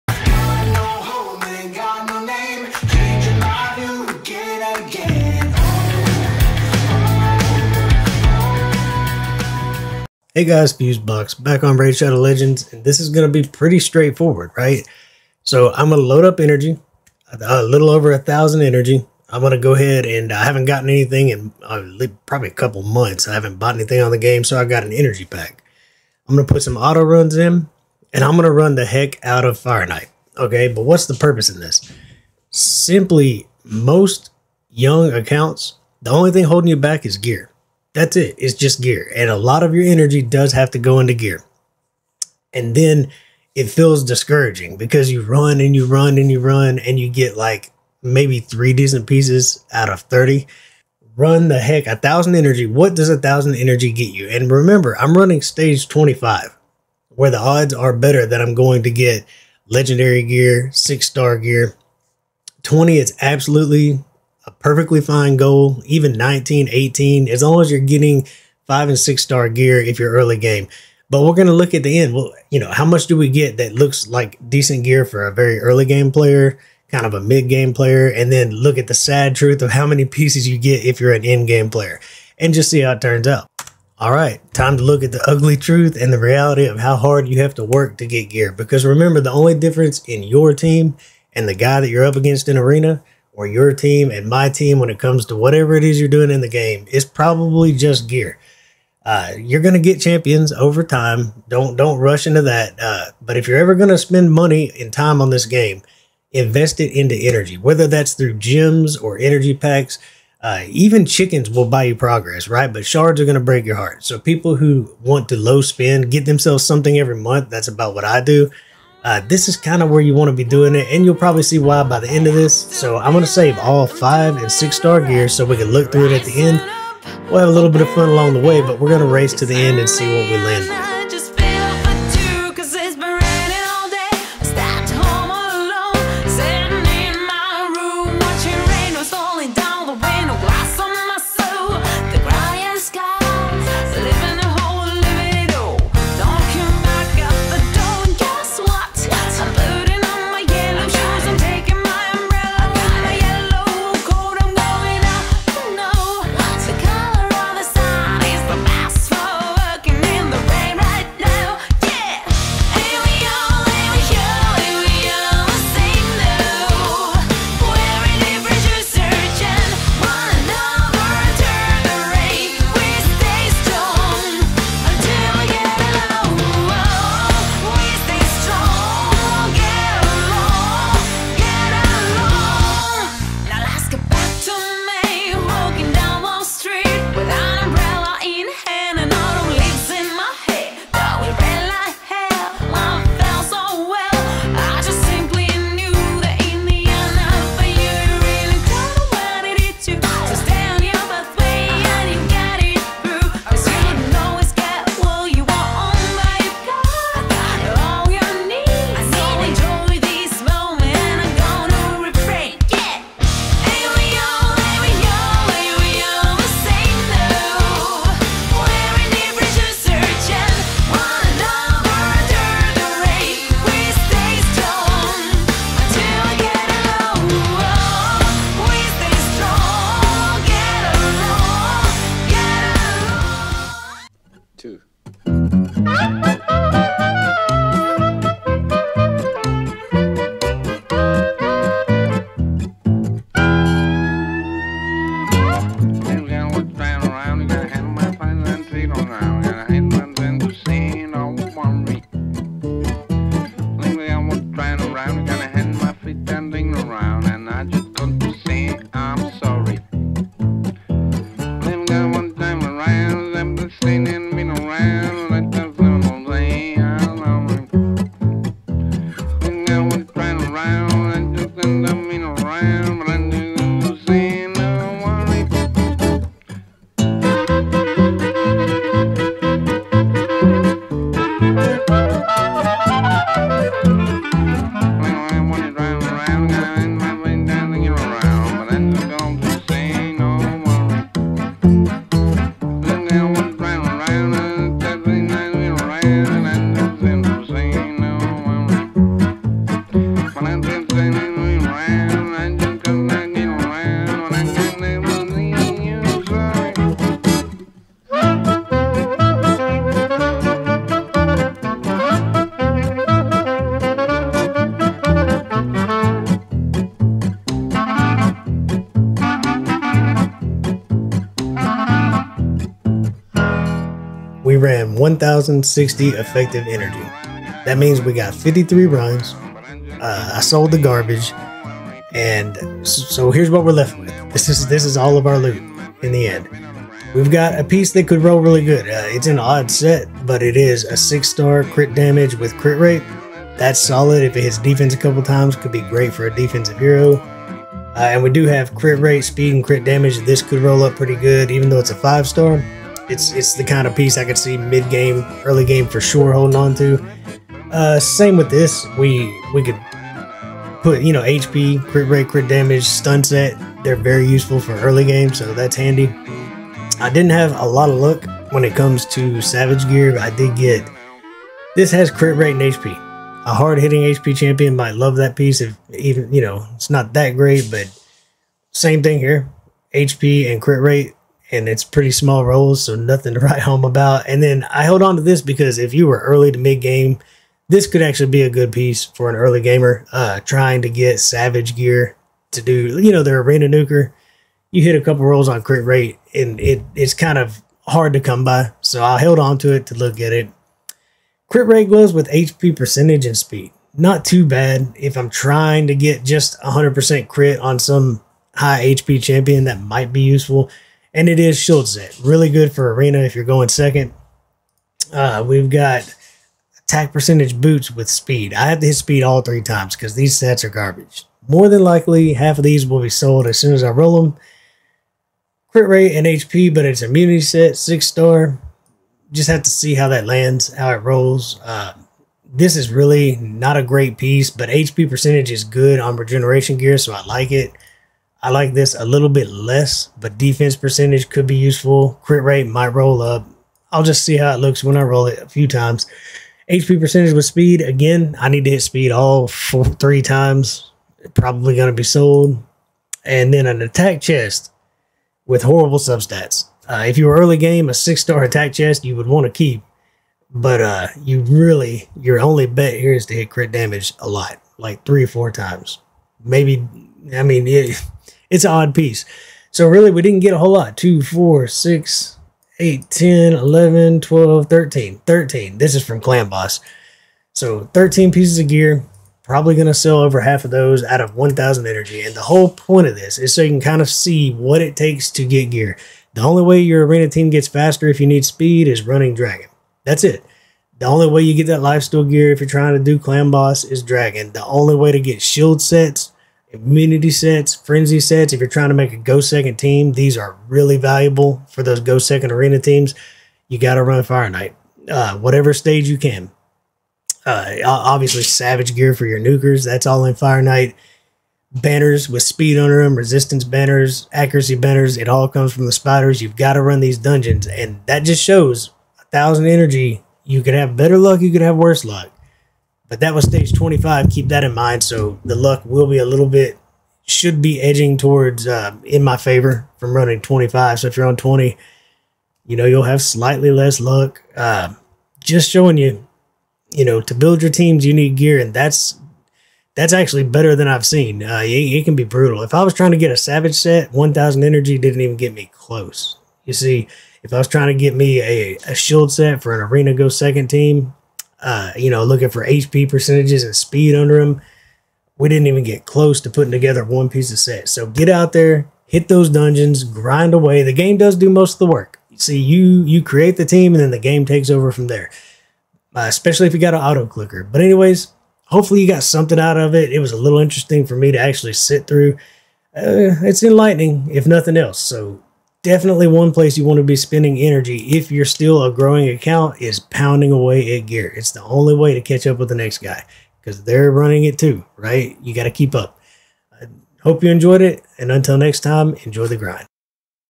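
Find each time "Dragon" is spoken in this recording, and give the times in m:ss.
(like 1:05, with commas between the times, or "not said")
8:09, 8:14.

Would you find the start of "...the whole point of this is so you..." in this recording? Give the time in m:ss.
8:02.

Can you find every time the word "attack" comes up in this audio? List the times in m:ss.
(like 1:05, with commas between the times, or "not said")
6:56, 7:33, 7:38.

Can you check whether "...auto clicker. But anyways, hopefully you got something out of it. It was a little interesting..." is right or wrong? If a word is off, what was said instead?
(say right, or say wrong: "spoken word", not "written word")
right.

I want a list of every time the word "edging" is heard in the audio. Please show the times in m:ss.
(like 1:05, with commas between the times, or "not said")
8:47.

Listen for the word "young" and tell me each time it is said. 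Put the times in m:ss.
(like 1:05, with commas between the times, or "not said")
0:34.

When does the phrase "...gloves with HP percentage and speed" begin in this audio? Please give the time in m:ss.
6:41.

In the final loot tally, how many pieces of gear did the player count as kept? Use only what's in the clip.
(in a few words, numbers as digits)
13.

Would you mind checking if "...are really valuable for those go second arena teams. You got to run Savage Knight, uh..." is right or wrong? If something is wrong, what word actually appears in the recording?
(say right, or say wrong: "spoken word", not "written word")
wrong: "Fire", not "Savage".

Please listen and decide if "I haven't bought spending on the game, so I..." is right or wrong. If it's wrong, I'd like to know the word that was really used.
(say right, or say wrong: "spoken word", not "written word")
wrong: "anything", not "spending".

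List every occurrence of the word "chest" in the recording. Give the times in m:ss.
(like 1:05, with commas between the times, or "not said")
7:34, 7:38.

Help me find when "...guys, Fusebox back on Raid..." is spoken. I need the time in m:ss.
0:10.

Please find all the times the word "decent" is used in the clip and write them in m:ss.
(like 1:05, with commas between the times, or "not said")
0:48, 1:14.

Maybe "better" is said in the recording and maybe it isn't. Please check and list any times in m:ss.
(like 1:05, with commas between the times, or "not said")
0:57, 8:40, 9:00.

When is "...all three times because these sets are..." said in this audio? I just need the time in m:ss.
6:59.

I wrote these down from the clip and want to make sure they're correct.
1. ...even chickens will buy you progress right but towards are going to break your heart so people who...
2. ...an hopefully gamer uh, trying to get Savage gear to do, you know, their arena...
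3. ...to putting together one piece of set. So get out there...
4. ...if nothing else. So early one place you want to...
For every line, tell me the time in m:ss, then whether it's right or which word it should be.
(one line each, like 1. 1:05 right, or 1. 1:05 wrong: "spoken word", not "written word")
1. 1:50 wrong: "shards", not "towards"
2. 6:29 wrong: "early", not "hopefully"
3. 9:16 right
4. 9:34 wrong: "definitely", not "early".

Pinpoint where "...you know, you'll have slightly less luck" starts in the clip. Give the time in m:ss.
8:52.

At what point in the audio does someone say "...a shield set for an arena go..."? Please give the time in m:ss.
9:08.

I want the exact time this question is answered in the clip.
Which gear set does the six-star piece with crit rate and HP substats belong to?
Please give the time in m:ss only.
7:07.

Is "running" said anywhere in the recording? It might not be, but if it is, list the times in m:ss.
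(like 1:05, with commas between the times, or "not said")
0:55, 8:09, 8:50, 9:44.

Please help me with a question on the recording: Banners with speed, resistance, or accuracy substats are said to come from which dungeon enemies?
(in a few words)
The spiders.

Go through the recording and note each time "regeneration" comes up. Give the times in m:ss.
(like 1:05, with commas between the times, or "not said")
7:16.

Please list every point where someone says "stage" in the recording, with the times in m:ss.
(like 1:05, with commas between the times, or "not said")
0:55, 8:25, 8:43.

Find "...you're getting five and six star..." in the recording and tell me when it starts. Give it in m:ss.
1:07.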